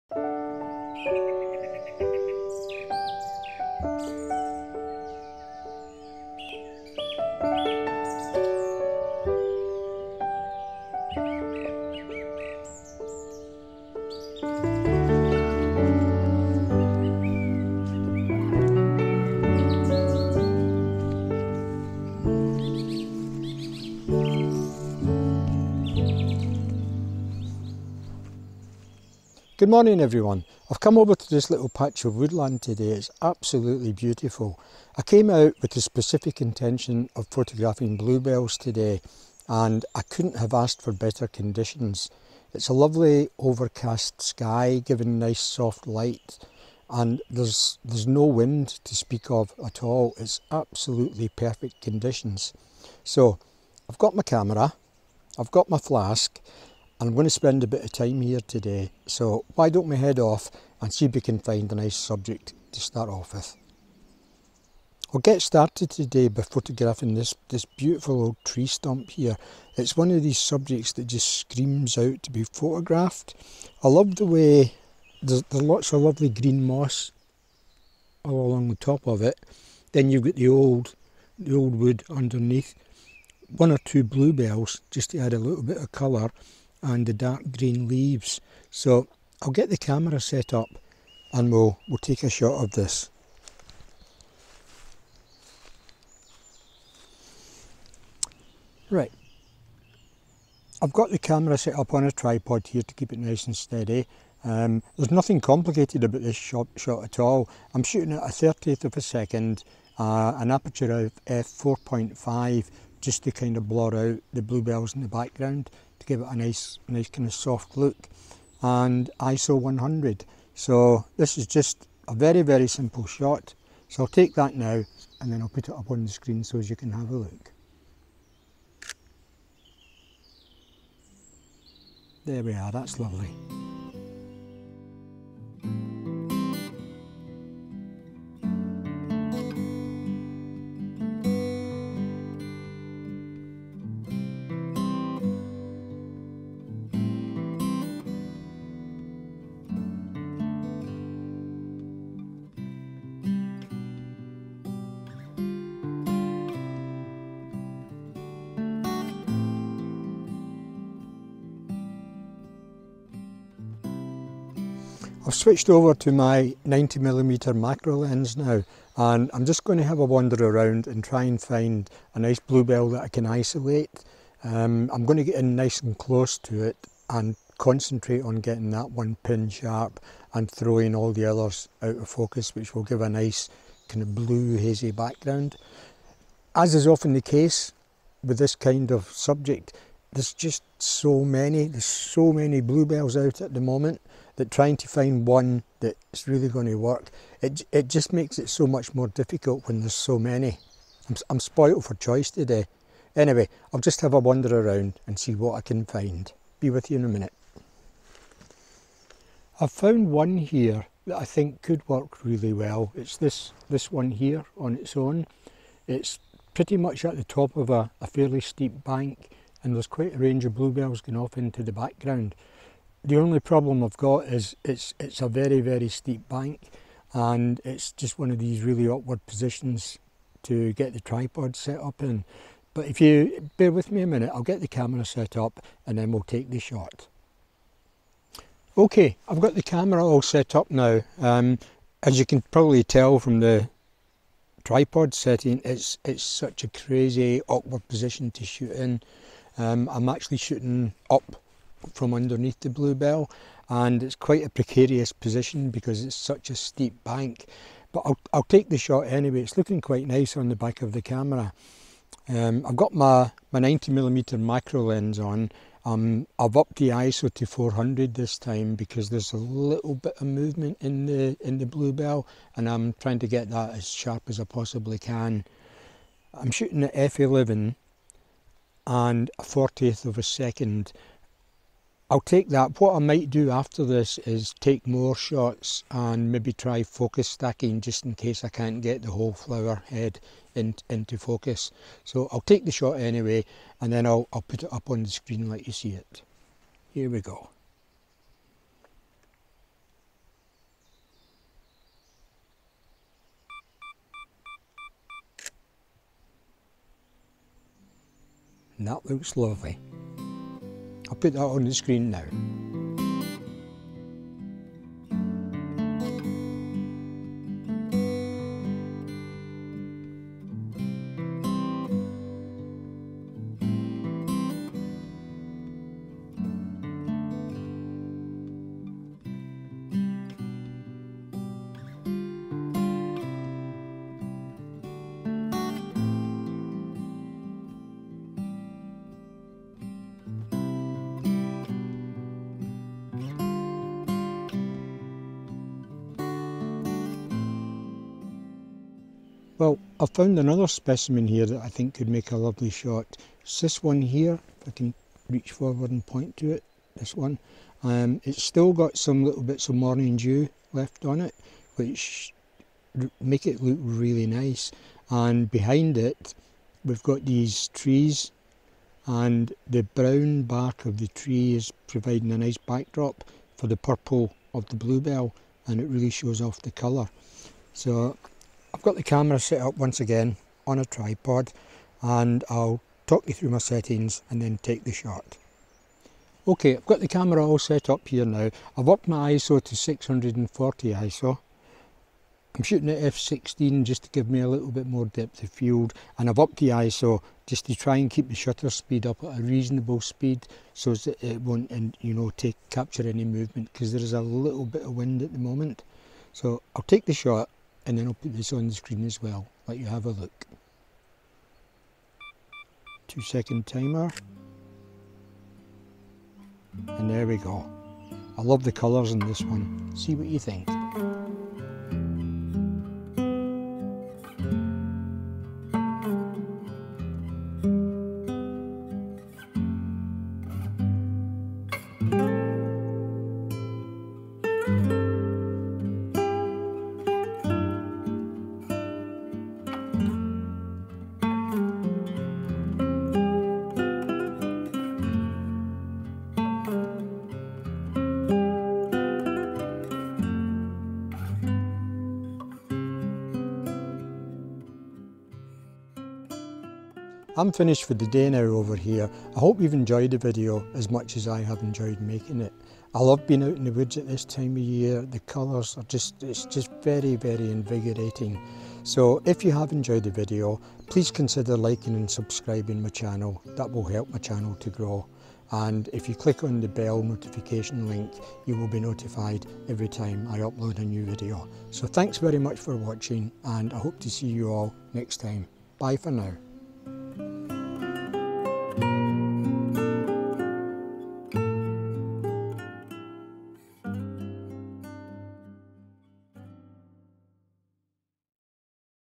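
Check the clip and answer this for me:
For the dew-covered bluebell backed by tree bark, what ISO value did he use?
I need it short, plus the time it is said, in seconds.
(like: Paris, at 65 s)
640, at 389 s.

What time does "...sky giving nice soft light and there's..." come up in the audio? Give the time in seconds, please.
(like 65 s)
44 s.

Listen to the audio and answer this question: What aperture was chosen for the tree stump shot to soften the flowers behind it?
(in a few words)
f4.5.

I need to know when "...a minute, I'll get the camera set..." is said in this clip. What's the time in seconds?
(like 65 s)
234 s.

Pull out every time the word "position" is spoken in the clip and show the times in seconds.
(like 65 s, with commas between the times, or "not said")
229 s, 247 s, 255 s.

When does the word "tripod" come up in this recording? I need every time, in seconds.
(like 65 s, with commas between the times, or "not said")
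102 s, 230 s, 244 s, 380 s.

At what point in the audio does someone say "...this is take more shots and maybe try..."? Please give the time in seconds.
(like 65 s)
283 s.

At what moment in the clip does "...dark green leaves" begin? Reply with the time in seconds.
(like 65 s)
87 s.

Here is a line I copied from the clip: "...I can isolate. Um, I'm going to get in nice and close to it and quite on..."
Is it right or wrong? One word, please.
wrong.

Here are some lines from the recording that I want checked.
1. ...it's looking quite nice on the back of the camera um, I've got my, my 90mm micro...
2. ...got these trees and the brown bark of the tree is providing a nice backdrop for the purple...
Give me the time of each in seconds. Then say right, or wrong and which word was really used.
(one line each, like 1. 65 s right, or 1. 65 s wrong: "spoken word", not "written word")
1. 259 s right
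2. 367 s right.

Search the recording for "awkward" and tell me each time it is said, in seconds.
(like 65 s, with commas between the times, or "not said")
228 s, 247 s.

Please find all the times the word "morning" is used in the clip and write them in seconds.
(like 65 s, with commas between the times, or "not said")
29 s, 359 s.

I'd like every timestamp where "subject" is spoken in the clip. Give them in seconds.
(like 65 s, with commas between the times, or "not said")
61 s, 70 s, 189 s.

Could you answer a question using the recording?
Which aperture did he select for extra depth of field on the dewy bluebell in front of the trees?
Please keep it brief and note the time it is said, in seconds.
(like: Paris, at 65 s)
f16, at 392 s.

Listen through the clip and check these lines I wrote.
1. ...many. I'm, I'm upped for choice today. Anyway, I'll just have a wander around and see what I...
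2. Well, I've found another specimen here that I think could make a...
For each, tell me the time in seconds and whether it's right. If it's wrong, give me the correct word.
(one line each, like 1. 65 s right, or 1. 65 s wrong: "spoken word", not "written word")
1. 200 s wrong: "spoiled", not "upped"
2. 349 s right.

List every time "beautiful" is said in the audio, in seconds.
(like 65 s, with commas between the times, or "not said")
33 s, 67 s.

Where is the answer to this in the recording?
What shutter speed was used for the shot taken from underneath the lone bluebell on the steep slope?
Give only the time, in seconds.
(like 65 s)
279 s.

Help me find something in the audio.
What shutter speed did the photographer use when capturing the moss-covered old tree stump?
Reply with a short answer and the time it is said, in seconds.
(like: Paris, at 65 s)
1/30 second, at 108 s.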